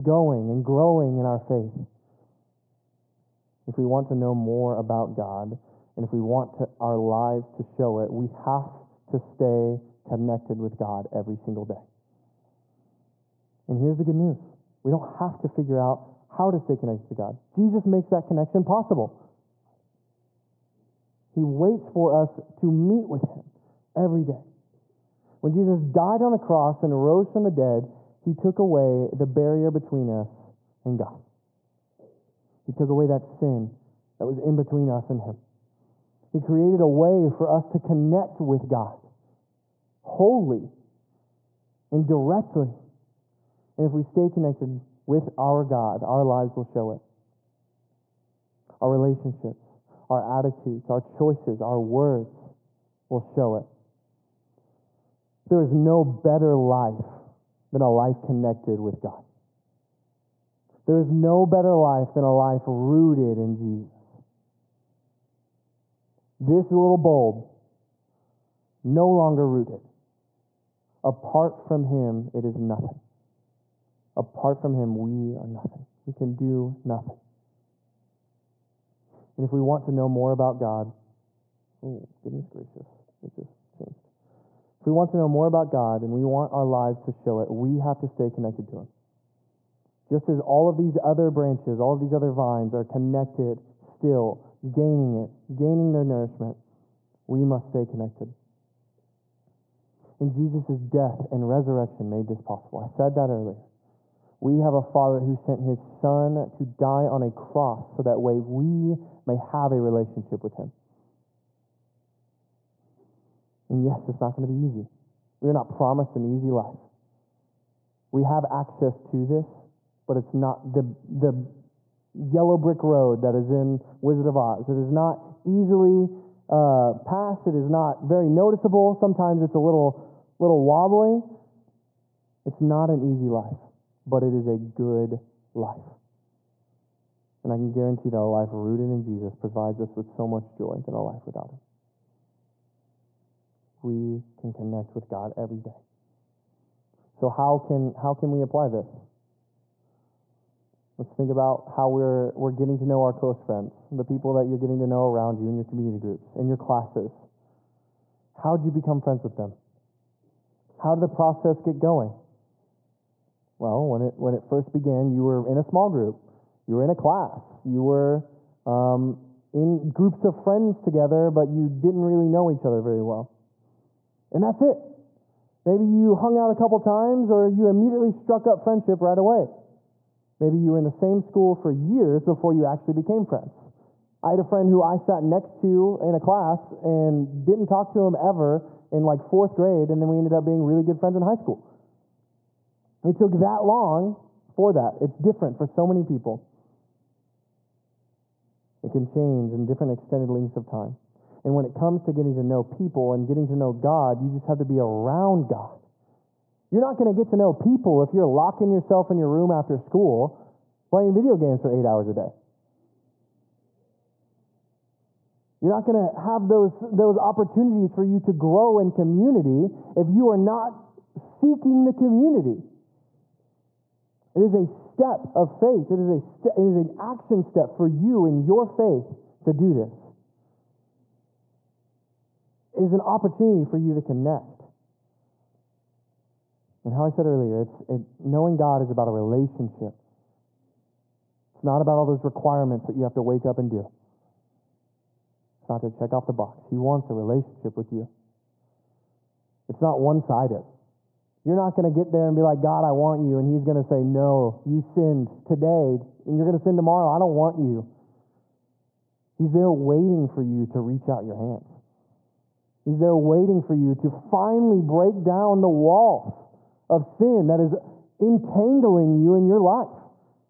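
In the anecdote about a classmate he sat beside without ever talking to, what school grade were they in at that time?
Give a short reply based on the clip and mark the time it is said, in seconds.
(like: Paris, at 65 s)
fourth grade, at 189 s.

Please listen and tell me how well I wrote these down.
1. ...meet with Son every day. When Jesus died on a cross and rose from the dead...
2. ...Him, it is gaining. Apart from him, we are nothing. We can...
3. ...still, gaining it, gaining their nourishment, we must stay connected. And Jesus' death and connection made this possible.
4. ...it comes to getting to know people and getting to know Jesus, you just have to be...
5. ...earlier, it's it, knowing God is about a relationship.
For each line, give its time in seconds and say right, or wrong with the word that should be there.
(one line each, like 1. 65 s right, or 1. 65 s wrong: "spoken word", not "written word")
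1. 22 s wrong: "Him", not "Son"
2. 71 s wrong: "nothing", not "gaining"
3. 93 s wrong: "resurrection", not "connection"
4. 201 s wrong: "God", not "Jesus"
5. 237 s right.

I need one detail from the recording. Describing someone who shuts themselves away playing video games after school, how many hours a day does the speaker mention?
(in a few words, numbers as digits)
8.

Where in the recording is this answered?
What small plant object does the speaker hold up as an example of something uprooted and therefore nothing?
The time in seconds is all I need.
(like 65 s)
66 s.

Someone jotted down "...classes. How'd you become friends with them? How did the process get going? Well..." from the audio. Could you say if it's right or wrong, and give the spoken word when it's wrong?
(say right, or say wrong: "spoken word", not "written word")
right.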